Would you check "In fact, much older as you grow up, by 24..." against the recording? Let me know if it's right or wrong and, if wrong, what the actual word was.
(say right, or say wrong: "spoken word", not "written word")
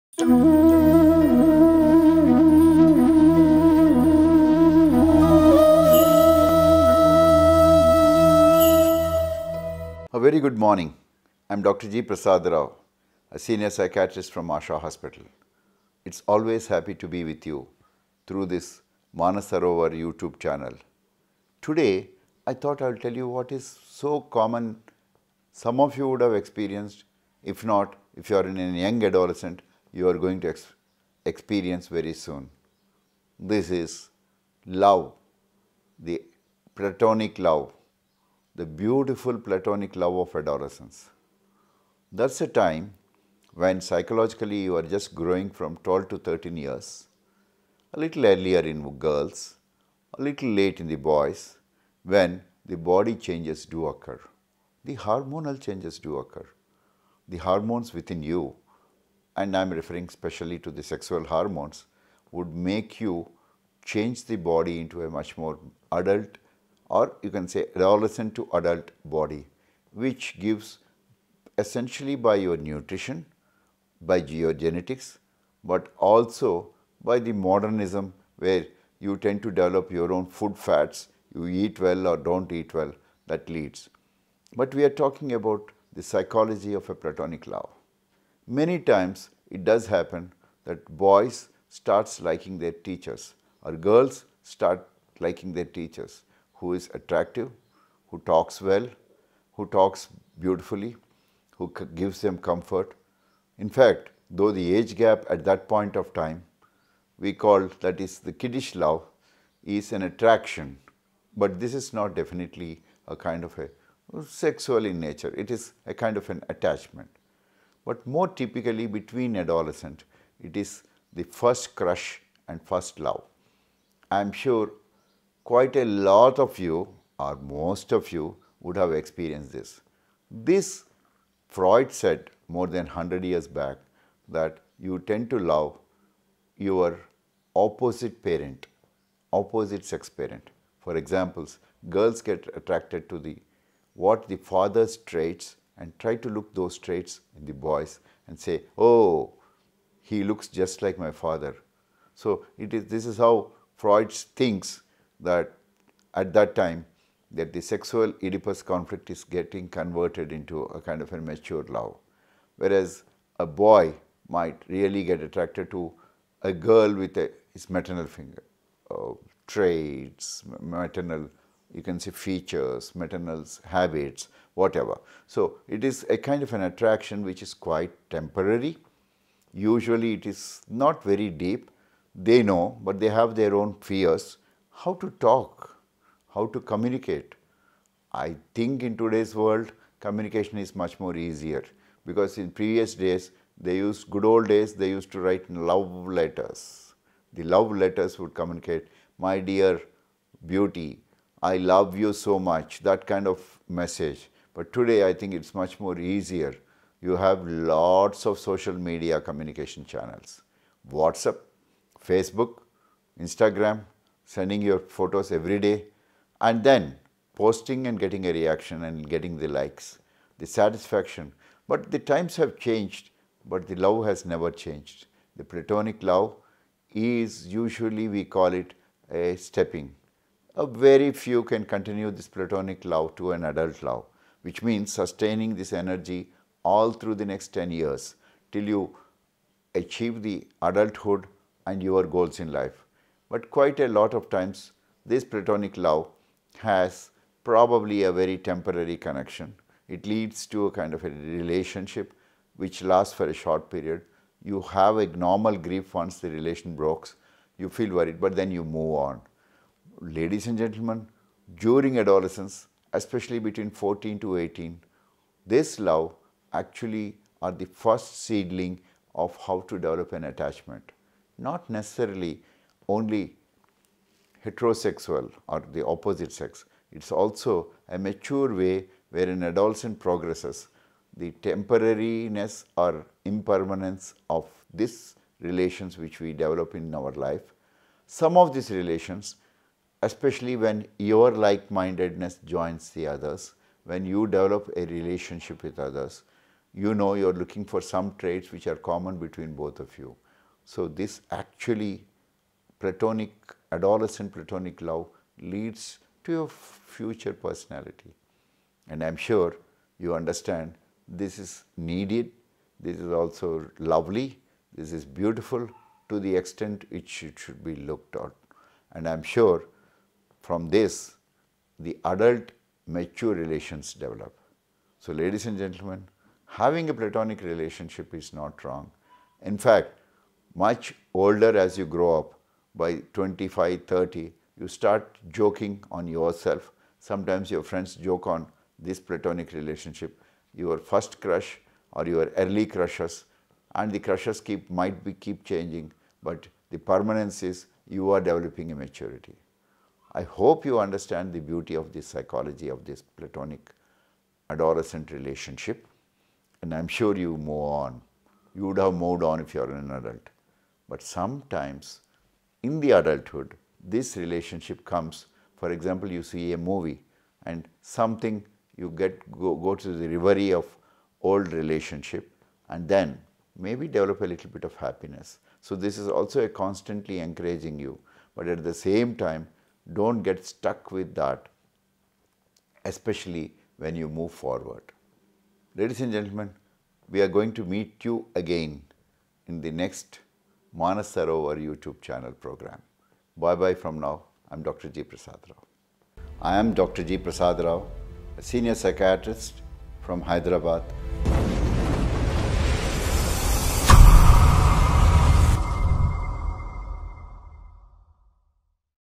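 wrong: "25", not "24".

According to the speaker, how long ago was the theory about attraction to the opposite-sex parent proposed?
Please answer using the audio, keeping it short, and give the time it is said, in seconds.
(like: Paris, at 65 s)
More than 100 years, at 132 s.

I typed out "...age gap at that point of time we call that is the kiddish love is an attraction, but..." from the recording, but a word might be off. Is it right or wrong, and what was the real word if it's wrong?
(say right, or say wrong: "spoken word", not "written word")
right.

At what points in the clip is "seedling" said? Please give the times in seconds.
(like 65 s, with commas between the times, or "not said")
268 s.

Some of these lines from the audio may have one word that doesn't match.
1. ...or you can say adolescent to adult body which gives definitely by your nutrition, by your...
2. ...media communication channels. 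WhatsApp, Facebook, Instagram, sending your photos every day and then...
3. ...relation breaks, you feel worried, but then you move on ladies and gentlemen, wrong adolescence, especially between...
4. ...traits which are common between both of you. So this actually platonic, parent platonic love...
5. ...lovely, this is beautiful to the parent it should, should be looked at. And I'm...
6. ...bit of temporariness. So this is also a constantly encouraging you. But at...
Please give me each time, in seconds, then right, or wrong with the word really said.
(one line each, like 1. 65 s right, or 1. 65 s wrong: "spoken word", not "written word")
1. 66 s wrong: "essentially", not "definitely"
2. 208 s right
3. 256 s wrong: "during", not "wrong"
4. 298 s wrong: "adolescent", not "parent"
5. 313 s wrong: "extent", not "parent"
6. 374 s wrong: "happiness", not "temporariness".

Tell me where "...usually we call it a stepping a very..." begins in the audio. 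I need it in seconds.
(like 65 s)
227 s.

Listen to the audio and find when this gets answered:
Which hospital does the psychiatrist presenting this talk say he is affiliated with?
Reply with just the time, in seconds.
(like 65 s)
14 s.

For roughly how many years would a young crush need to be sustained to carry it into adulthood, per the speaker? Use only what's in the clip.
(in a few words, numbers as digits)
10 years.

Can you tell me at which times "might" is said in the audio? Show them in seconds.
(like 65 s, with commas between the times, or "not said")
164 s, 344 s.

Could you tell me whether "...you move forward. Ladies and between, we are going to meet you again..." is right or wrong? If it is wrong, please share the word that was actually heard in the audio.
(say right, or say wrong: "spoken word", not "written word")
wrong: "gentlemen", not "between".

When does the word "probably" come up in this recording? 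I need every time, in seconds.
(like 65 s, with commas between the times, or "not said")
247 s.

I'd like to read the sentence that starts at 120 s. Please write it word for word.
It is the first crush and first love.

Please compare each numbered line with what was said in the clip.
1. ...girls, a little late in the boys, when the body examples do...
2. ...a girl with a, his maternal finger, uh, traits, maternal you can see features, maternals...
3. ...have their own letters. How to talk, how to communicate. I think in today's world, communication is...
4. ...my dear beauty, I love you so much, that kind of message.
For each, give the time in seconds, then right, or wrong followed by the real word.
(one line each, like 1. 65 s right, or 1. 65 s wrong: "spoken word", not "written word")
1. 48 s wrong: "changes", not "examples"
2. 166 s right
3. 183 s wrong: "fears", not "letters"
4. 199 s right.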